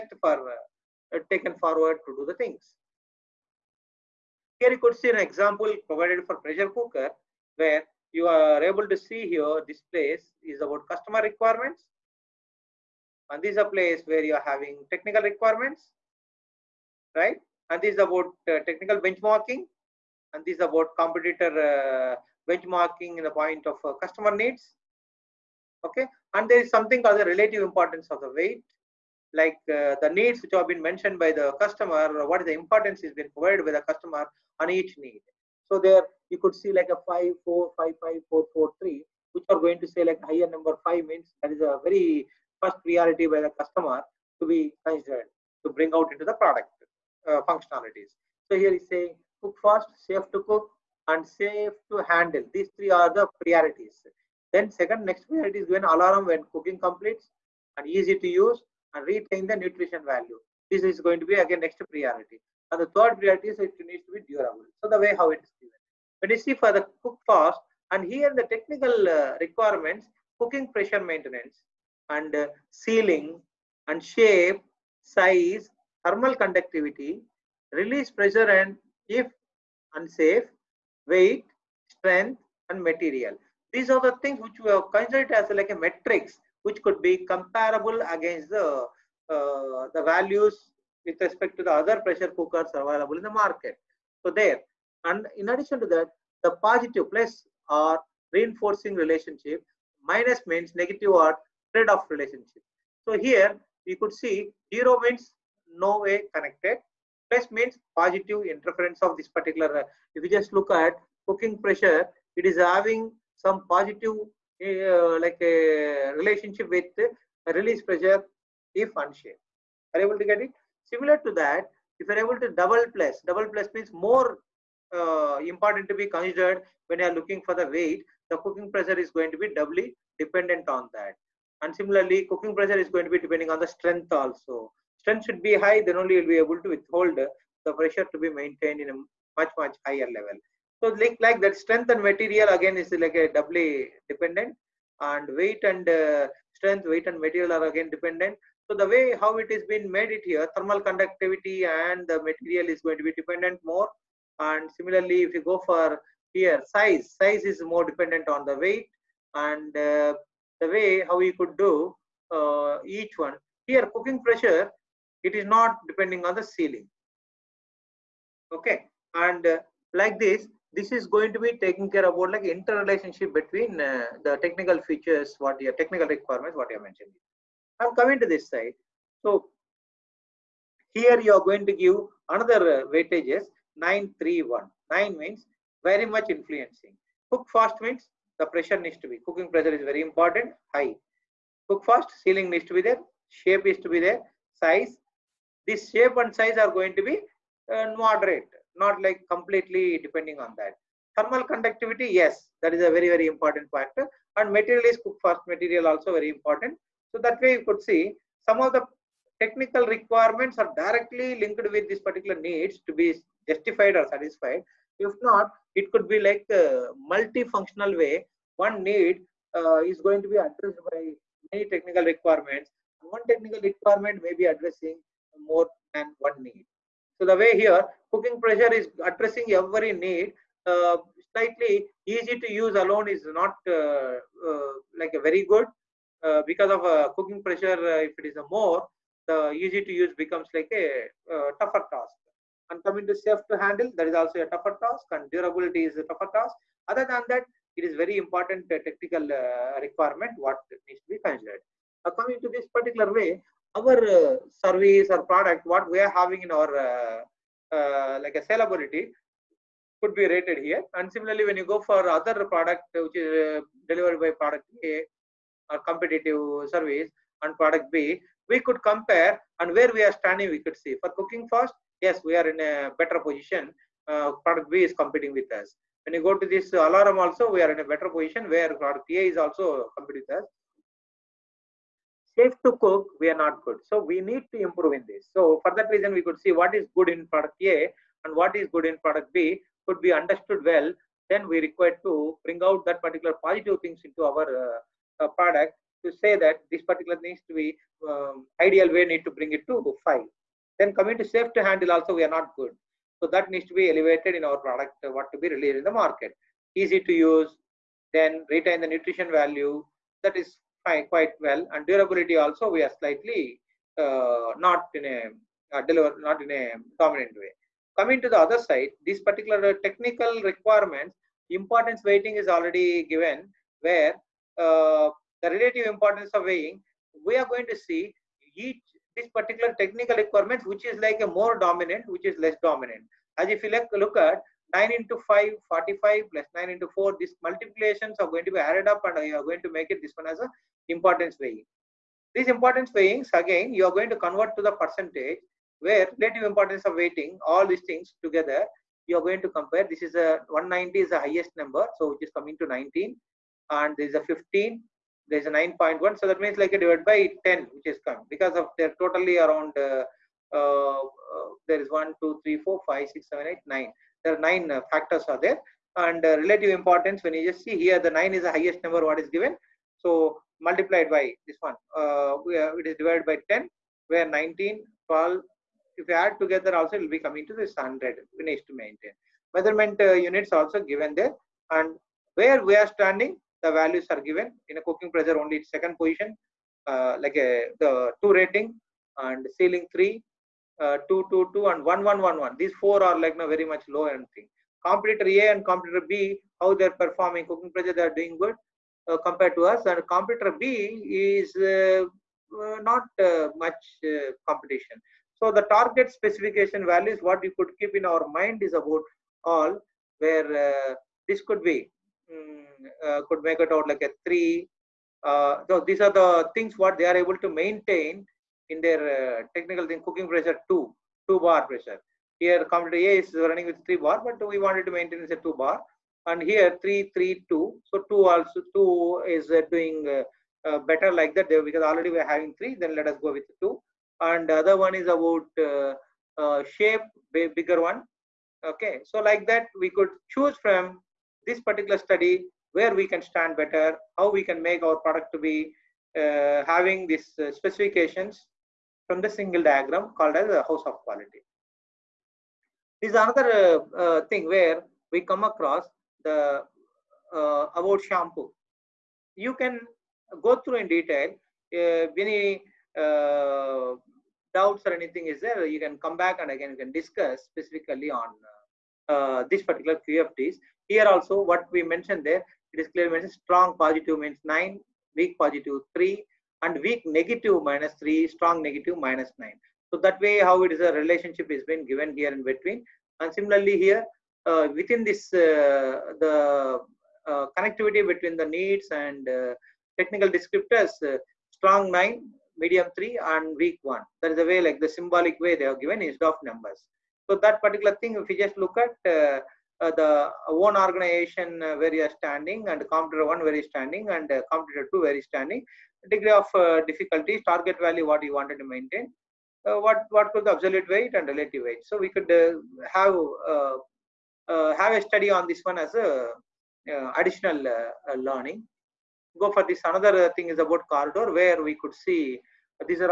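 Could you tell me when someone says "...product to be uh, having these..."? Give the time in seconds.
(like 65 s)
444 s.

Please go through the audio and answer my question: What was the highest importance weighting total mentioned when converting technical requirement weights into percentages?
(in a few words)
190.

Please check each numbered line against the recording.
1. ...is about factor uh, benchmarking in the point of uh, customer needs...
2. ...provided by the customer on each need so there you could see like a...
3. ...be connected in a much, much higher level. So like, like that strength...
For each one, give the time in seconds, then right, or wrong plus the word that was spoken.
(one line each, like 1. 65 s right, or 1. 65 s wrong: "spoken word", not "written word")
1. 20 s wrong: "competitor", not "factor"
2. 33 s right
3. 138 s wrong: "maintained", not "connected".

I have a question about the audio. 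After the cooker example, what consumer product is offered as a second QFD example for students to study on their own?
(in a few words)
Shampoo.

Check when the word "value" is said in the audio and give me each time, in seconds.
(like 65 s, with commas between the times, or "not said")
60 s, 90 s, 309 s, 383 s, 406 s, 507 s.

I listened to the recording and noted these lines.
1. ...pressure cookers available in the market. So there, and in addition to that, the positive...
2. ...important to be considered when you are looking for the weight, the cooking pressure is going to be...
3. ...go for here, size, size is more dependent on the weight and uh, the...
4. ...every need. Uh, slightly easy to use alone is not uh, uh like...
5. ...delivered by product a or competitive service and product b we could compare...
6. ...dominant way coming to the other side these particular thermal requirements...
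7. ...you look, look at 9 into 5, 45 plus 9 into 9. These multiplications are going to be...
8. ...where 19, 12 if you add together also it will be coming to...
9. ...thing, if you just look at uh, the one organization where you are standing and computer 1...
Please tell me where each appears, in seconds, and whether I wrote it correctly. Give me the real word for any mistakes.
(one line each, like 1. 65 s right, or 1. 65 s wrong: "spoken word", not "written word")
1. 92 s right
2. 125 s right
3. 155 s right
4. 229 s right
5. 263 s right
6. 316 s wrong: "technical", not "thermal"
7. 333 s wrong: "4", not "9"
8. 374 s right
9. 497 s right.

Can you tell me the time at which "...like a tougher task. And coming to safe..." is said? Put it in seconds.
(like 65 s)
240 s.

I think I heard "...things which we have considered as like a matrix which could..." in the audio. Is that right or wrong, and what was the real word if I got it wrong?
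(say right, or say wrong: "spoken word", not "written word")
right.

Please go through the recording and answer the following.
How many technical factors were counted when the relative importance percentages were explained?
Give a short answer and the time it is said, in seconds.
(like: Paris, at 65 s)
9, at 364 s.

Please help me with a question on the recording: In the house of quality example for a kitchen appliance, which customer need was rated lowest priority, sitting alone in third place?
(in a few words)
Durable.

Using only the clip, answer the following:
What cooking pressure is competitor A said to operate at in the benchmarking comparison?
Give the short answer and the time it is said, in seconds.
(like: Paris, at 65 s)
3 bar, at 423 s.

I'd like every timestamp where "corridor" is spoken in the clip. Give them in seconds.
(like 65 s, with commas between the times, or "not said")
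520 s.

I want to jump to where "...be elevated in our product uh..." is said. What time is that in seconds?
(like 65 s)
303 s.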